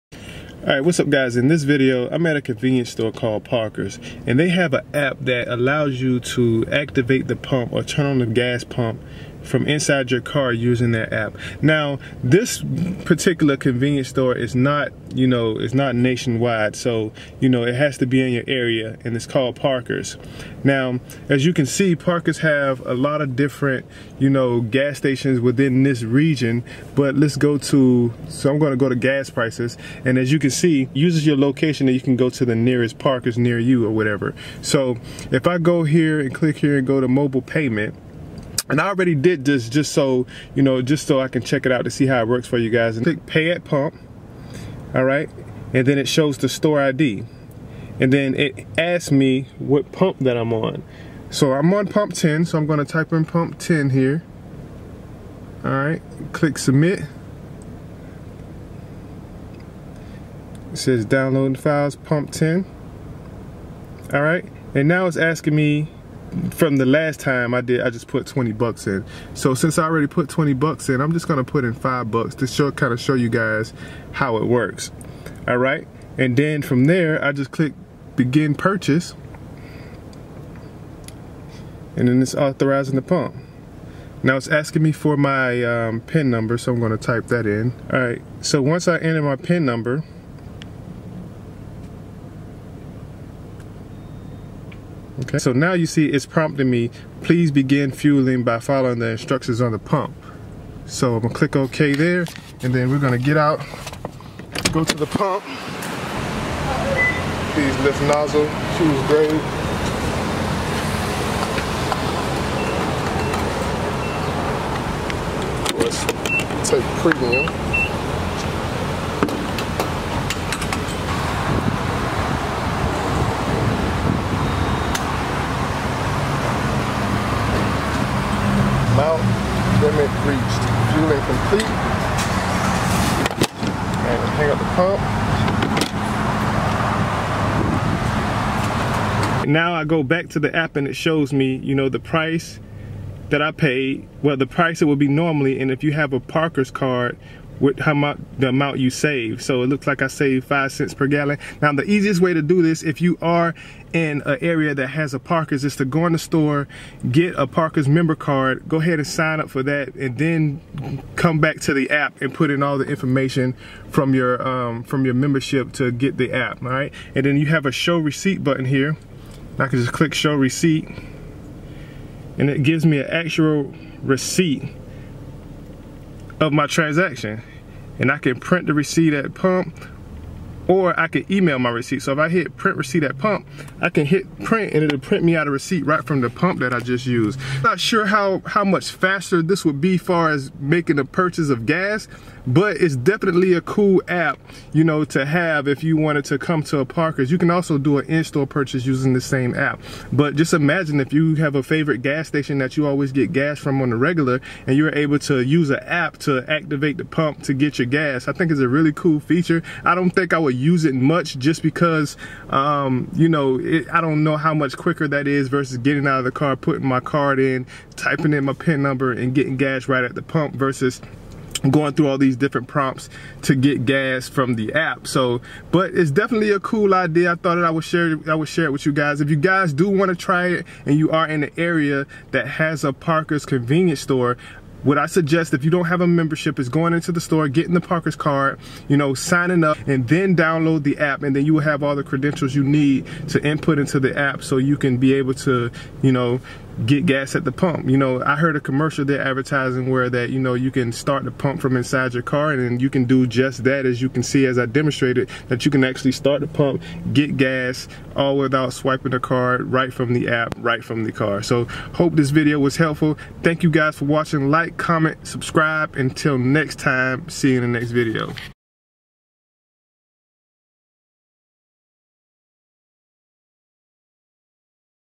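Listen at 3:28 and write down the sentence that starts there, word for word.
I think it's a really cool feature.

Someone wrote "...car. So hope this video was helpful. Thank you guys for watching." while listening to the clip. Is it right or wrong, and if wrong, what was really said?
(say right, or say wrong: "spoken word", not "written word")
right.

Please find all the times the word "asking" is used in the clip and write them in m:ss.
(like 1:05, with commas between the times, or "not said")
1:05, 1:24.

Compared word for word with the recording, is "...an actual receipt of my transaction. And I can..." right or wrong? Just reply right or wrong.
right.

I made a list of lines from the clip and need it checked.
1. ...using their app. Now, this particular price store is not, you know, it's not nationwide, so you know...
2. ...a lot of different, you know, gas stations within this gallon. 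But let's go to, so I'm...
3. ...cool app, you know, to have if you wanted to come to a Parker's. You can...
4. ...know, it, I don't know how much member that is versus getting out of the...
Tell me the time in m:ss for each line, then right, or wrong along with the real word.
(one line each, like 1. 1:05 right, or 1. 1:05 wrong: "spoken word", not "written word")
1. 0:10 wrong: "convenience", not "price"
2. 0:22 wrong: "region", not "gallon"
3. 3:13 right
4. 3:33 wrong: "quicker", not "member".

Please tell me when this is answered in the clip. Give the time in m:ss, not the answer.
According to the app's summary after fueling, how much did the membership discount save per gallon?
2:30.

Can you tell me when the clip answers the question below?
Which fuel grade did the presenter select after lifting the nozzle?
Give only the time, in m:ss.
1:57.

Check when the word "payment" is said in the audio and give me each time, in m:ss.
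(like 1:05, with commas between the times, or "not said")
0:37.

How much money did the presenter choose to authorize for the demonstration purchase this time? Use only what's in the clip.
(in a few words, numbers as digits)
$5.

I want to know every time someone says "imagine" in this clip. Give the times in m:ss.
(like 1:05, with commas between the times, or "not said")
3:20.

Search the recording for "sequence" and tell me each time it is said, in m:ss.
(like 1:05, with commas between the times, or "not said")
not said.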